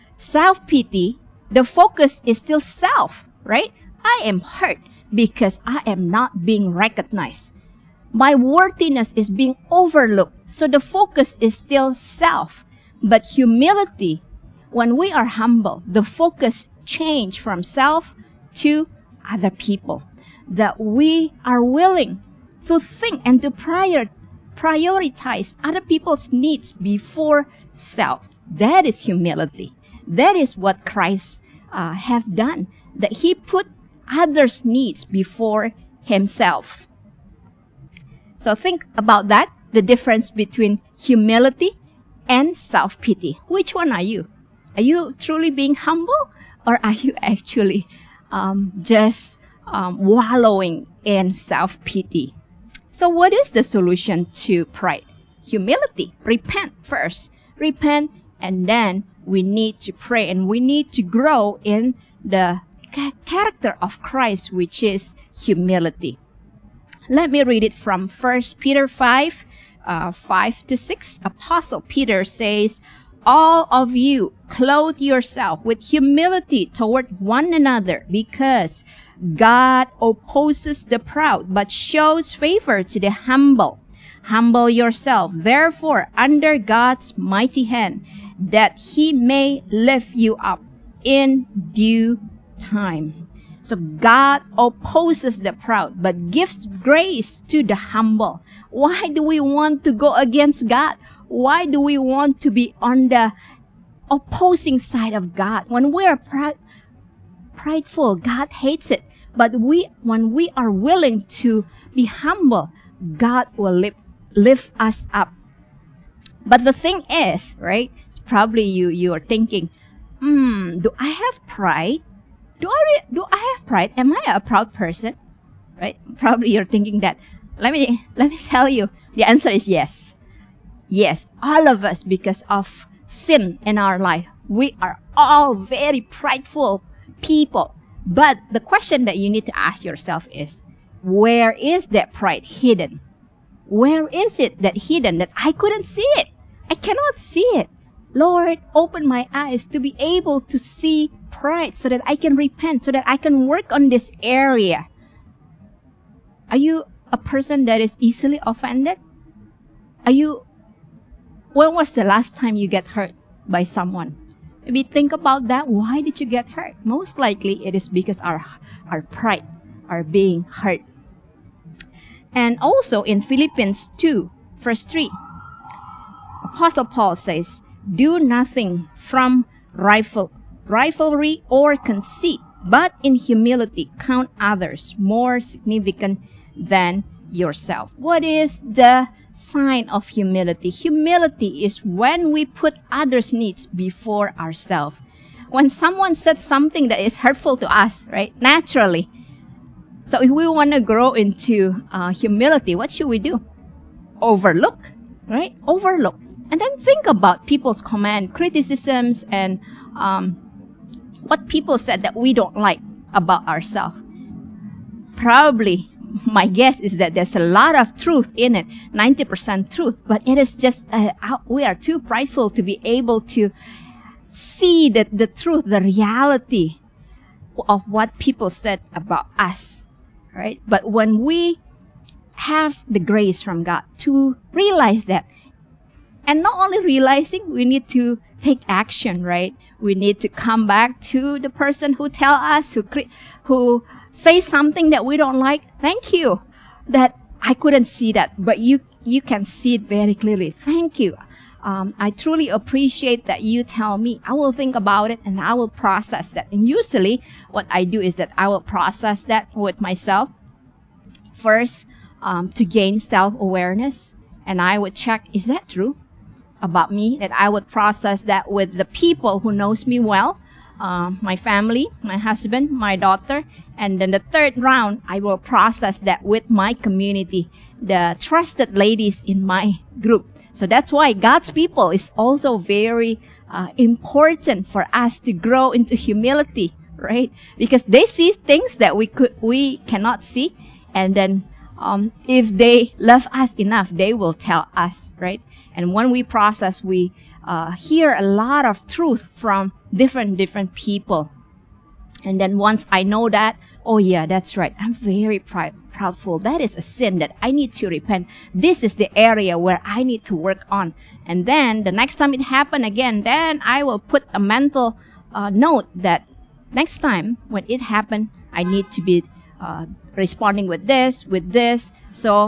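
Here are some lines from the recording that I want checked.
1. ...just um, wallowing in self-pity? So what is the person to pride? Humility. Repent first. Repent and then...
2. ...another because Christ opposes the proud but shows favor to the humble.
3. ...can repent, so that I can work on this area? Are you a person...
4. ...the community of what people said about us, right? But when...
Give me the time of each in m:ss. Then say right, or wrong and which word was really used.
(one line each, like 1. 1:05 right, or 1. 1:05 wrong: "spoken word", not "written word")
1. 0:48 wrong: "solution", not "person"
2. 1:17 wrong: "God", not "Christ"
3. 2:32 right
4. 3:45 wrong: "reality", not "community".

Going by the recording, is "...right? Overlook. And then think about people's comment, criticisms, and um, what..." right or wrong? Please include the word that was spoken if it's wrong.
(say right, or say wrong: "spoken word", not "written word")
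right.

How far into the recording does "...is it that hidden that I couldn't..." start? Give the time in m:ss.
2:24.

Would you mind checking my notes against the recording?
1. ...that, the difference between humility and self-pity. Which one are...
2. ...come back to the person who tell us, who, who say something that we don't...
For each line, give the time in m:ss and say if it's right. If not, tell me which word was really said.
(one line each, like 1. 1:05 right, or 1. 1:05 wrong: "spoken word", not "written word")
1. 0:39 right
2. 4:00 right.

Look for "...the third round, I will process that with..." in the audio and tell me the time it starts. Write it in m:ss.
4:34.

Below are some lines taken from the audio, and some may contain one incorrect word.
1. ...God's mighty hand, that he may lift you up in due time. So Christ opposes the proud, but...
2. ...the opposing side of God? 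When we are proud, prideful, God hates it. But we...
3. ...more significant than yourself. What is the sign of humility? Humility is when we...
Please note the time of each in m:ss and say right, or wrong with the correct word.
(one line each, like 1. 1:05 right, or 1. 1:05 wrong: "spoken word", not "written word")
1. 1:26 wrong: "God", not "Christ"
2. 1:43 right
3. 3:04 right.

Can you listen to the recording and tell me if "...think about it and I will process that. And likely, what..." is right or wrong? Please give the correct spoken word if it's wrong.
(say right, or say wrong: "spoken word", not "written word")
wrong: "usually", not "likely".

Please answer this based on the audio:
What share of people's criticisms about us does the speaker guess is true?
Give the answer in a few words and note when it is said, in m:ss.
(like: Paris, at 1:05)
90%, at 3:38.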